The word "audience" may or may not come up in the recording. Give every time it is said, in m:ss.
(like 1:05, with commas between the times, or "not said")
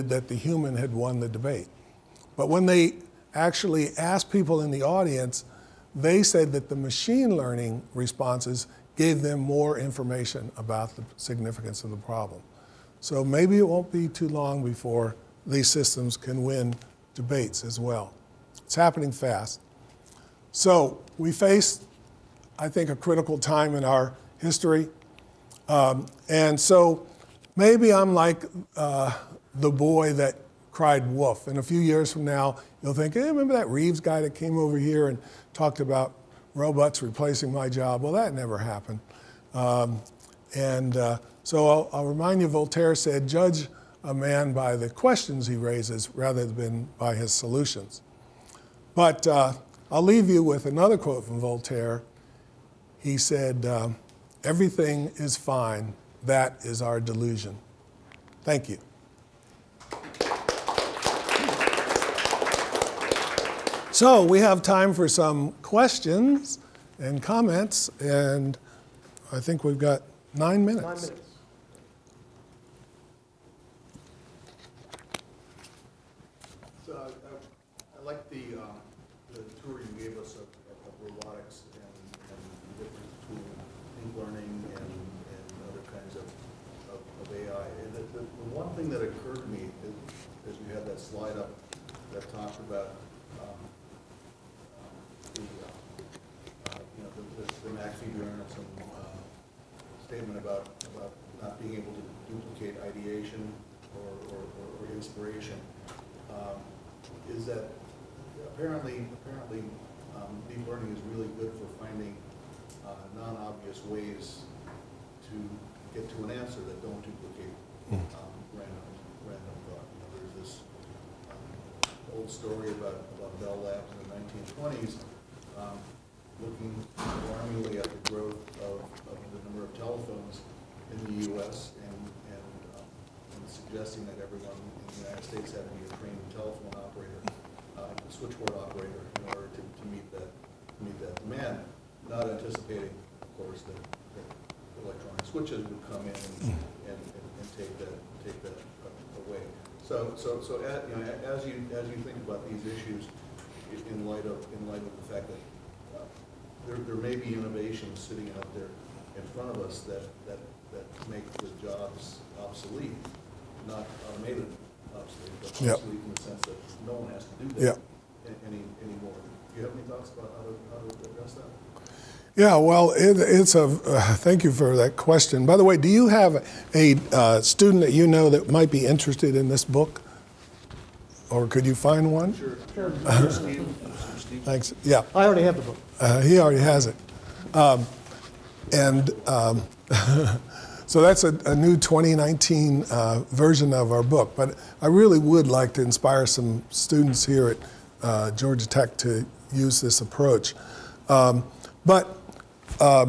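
0:04.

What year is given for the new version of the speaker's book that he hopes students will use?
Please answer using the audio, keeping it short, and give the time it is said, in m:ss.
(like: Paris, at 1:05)
2019, at 3:11.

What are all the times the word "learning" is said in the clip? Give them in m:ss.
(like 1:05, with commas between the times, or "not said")
0:07, 1:50.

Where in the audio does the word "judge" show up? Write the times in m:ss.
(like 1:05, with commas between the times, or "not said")
0:43.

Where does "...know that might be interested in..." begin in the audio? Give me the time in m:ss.
2:58.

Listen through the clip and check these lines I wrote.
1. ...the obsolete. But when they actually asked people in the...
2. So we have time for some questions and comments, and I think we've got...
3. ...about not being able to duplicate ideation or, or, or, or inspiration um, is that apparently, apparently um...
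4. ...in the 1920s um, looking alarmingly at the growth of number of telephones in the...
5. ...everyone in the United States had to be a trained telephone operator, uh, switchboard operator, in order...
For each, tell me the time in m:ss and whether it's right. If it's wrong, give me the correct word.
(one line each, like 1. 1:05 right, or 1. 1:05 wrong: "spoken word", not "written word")
1. 0:01 wrong: "debate", not "obsolete"
2. 1:03 right
3. 1:40 right
4. 2:03 right
5. 2:14 right.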